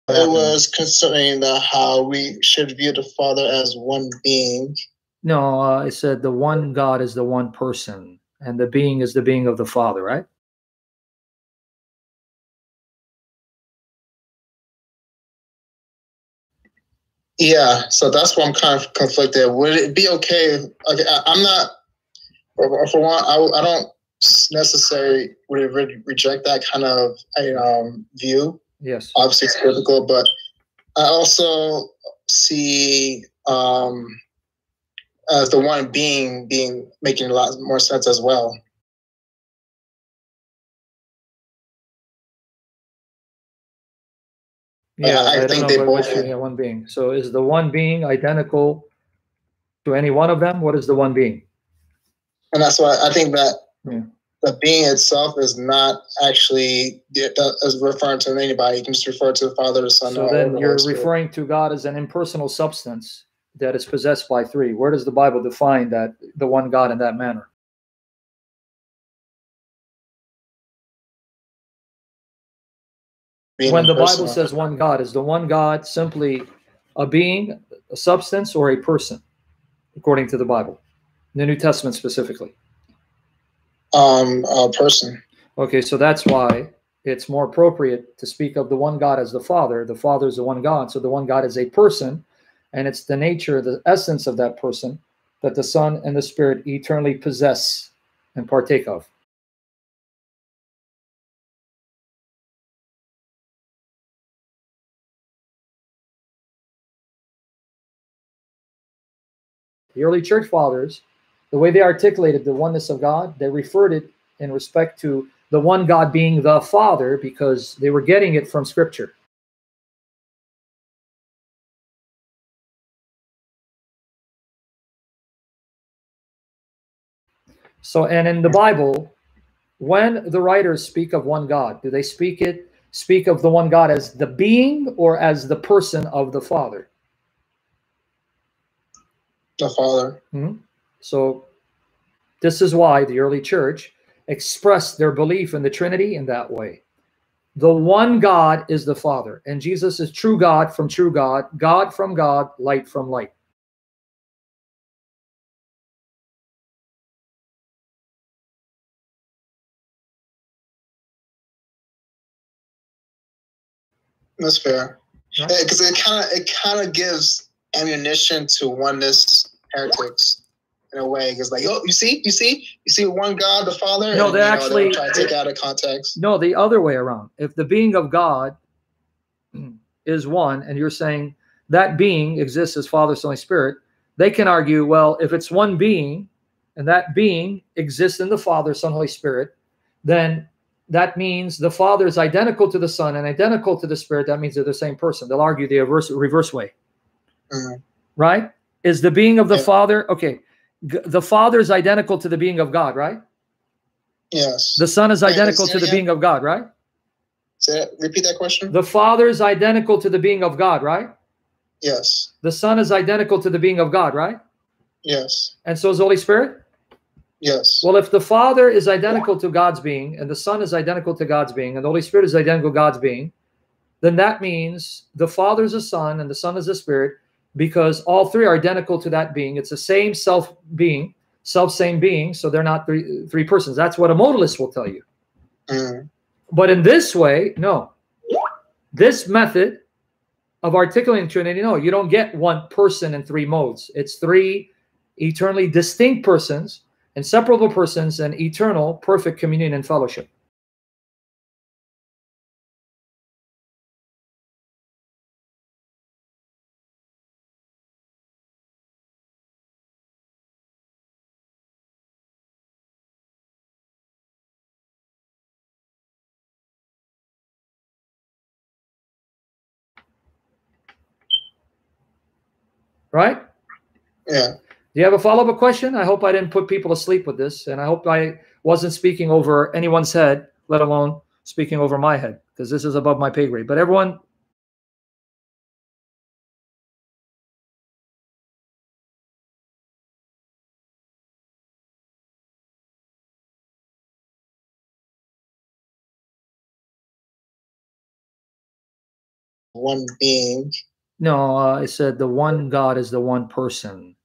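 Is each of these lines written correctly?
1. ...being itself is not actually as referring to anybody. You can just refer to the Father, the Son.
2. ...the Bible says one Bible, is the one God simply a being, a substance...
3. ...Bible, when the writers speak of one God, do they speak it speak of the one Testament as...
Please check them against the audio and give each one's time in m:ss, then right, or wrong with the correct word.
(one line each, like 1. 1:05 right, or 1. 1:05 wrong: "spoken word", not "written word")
1. 0:54 right
2. 1:13 wrong: "God", not "Bible"
3. 2:08 wrong: "God", not "Testament".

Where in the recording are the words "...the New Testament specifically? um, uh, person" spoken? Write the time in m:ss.
1:21.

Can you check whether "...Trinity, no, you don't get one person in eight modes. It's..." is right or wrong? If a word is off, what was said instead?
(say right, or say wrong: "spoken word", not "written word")
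wrong: "three", not "eight".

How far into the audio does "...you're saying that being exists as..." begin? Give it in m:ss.
3:00.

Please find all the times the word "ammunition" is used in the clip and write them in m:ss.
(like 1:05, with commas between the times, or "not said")
2:47.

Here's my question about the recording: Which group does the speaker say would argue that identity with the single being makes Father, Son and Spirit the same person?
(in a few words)
A modalist.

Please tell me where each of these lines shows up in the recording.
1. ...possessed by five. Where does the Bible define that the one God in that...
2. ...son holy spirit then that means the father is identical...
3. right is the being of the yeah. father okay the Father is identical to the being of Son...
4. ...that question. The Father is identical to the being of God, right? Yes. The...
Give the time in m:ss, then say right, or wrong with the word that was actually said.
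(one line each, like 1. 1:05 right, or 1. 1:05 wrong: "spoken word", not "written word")
1. 1:03 wrong: "three", not "five"
2. 3:08 right
3. 3:18 wrong: "God", not "Son"
4. 3:28 right.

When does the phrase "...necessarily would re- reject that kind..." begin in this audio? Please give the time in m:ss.
0:24.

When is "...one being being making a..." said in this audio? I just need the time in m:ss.
0:35.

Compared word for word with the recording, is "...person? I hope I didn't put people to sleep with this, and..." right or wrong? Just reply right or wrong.
wrong.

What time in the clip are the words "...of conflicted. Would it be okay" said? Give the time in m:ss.
0:18.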